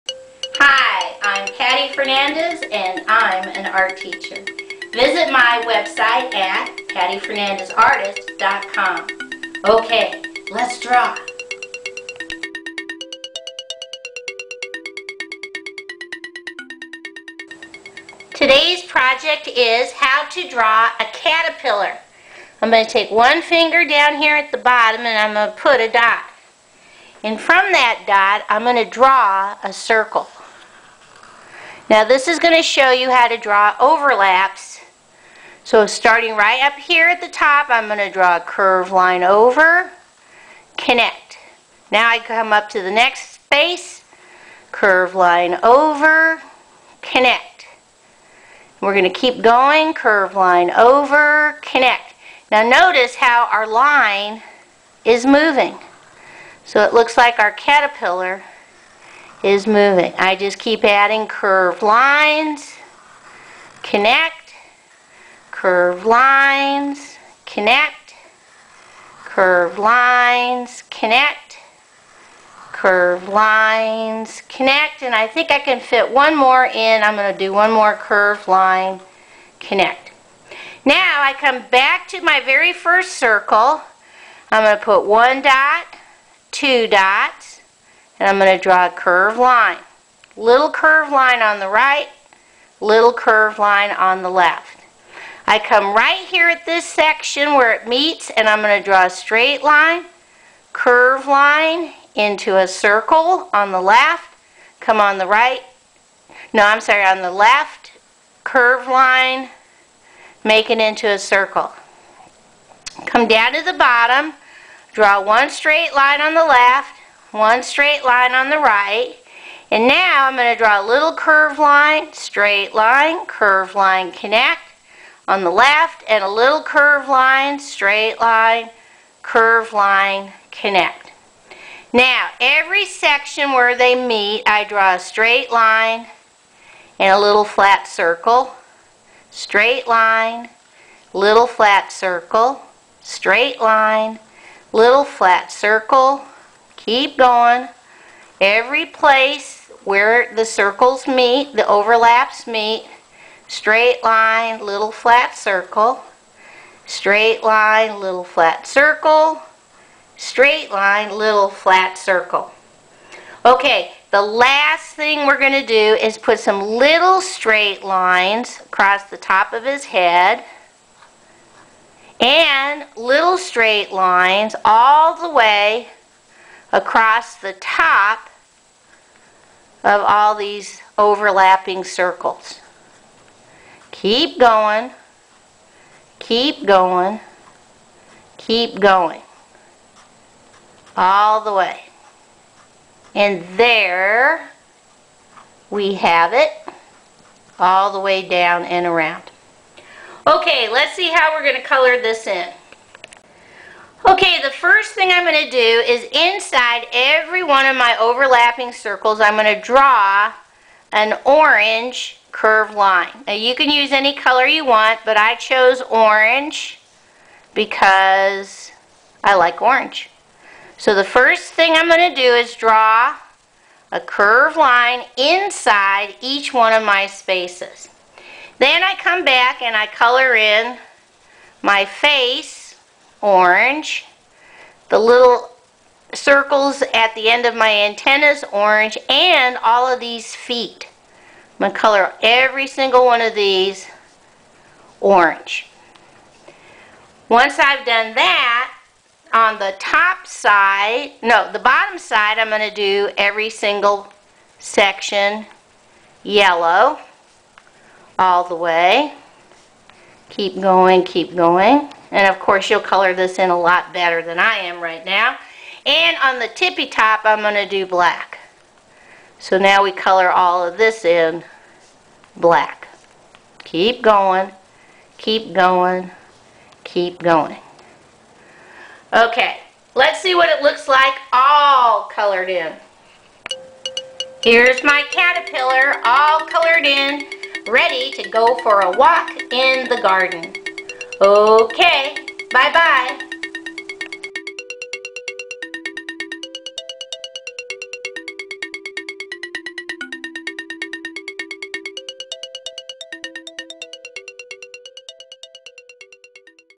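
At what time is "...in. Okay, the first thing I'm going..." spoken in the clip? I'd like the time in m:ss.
3:22.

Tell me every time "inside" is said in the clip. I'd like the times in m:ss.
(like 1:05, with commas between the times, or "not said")
3:26, 3:45.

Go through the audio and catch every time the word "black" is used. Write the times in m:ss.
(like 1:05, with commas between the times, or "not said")
4:27, 4:32.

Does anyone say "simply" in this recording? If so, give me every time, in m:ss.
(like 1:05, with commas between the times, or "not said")
not said.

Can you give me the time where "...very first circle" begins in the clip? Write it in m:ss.
1:22.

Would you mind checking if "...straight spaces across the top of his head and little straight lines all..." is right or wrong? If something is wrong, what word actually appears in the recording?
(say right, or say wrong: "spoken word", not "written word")
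wrong: "lines", not "spaces".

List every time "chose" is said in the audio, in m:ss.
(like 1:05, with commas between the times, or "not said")
3:35.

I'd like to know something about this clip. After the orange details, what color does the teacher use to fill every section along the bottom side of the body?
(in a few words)
yellow.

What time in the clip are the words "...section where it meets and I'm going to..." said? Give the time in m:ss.
1:36.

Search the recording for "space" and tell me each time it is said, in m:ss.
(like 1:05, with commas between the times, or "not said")
0:43, 3:47.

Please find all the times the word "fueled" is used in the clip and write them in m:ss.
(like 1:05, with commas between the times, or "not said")
not said.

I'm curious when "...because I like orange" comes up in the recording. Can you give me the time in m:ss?
3:37.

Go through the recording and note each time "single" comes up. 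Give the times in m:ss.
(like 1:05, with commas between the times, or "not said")
4:02, 4:13.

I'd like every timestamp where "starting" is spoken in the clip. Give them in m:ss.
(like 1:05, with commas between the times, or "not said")
0:35.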